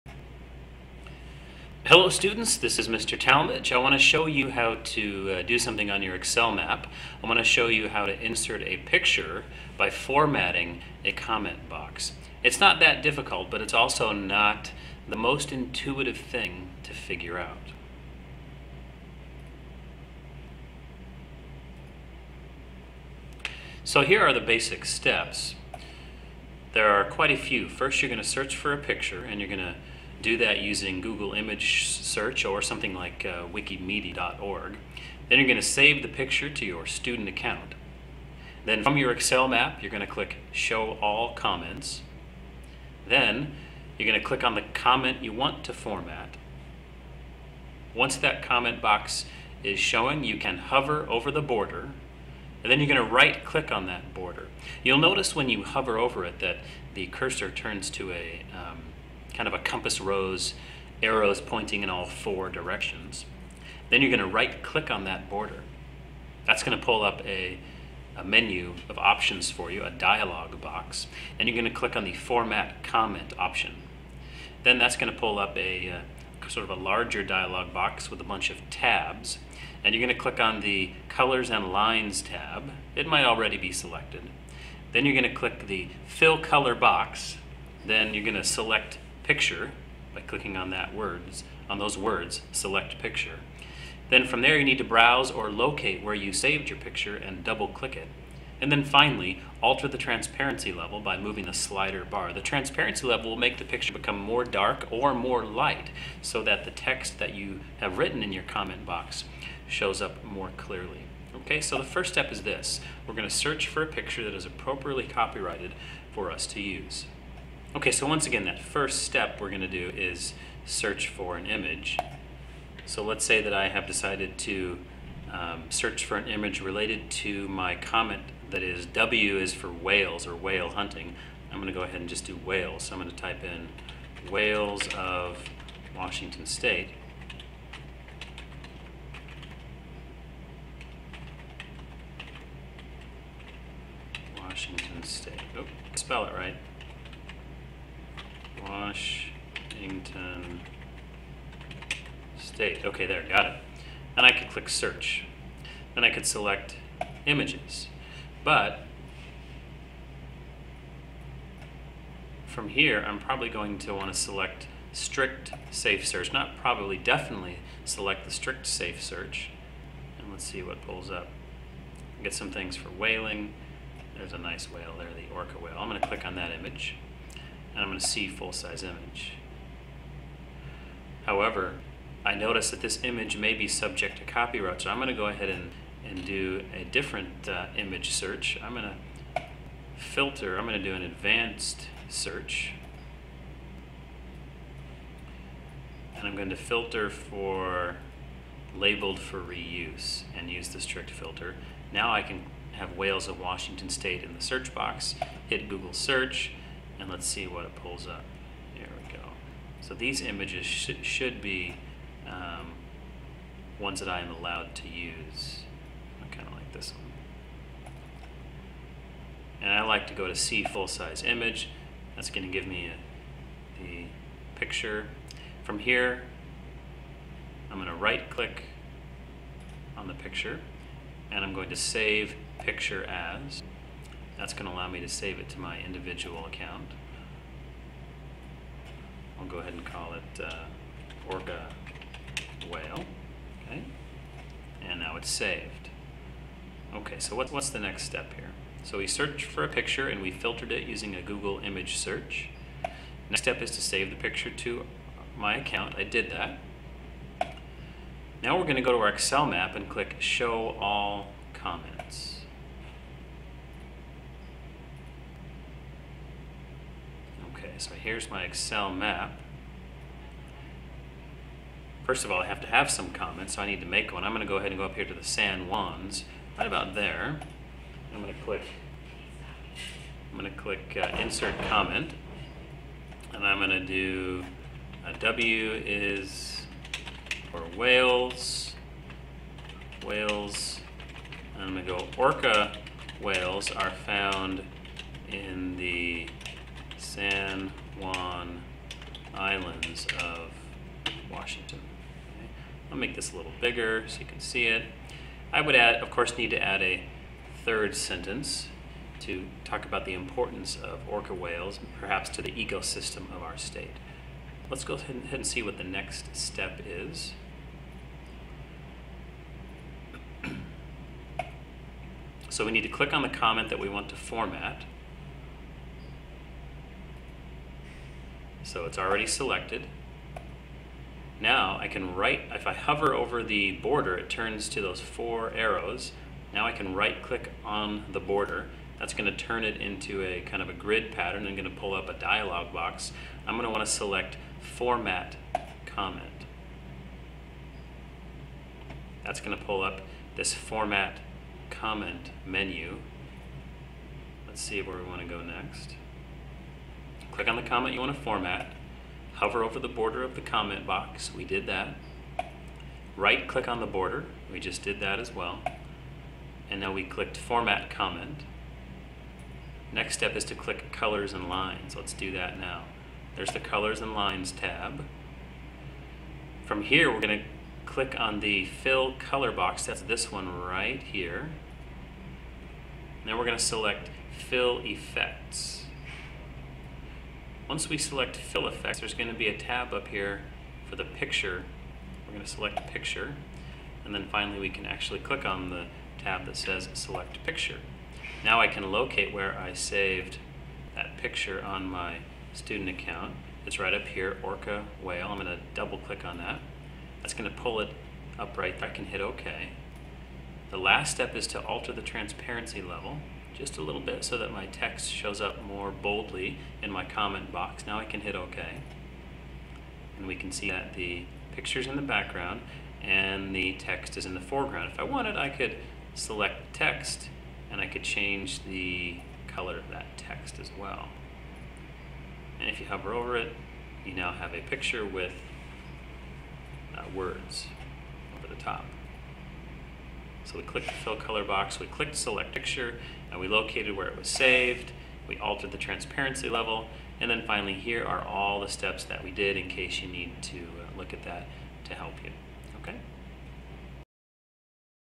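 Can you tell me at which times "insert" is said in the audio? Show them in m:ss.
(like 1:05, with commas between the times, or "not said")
0:08, 4:41.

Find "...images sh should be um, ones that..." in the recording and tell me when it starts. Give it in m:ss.
3:30.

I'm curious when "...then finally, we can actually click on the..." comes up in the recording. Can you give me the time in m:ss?
6:34.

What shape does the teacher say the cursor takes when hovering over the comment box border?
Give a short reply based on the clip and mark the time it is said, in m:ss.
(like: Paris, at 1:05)
compass rose, at 0:59.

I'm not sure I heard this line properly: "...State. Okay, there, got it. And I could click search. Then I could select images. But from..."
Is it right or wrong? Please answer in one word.
right.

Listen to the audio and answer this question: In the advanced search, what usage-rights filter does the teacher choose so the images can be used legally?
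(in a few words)
labeled for reuse.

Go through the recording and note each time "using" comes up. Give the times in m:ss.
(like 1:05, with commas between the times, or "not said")
0:30, 4:10.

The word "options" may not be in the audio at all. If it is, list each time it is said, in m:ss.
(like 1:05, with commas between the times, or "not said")
1:08, 1:13.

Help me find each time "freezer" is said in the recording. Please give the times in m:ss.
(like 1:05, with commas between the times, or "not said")
not said.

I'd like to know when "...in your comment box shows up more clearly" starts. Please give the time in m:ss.
1:48.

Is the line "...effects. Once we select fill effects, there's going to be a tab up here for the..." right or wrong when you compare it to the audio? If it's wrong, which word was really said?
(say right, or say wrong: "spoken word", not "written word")
right.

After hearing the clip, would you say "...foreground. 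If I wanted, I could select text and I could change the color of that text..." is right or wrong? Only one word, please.
right.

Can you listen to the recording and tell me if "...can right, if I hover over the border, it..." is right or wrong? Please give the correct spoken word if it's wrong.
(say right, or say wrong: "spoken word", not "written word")
right.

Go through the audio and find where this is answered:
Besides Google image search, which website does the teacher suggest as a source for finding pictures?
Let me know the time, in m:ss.
0:33.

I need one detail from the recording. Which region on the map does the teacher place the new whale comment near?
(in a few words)
San Juans.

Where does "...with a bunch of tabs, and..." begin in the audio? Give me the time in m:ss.
1:18.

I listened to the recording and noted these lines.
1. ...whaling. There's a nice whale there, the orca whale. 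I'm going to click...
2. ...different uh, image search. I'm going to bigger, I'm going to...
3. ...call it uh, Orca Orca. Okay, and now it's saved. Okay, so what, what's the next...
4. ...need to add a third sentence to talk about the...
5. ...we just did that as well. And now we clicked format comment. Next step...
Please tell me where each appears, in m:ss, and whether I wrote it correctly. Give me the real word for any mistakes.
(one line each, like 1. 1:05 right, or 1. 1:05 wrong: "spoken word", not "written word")
1. 2:52 right
2. 3:06 wrong: "filter", not "bigger"
3. 3:59 wrong: "Whale", not "Orca"
4. 5:06 right
5. 6:04 right.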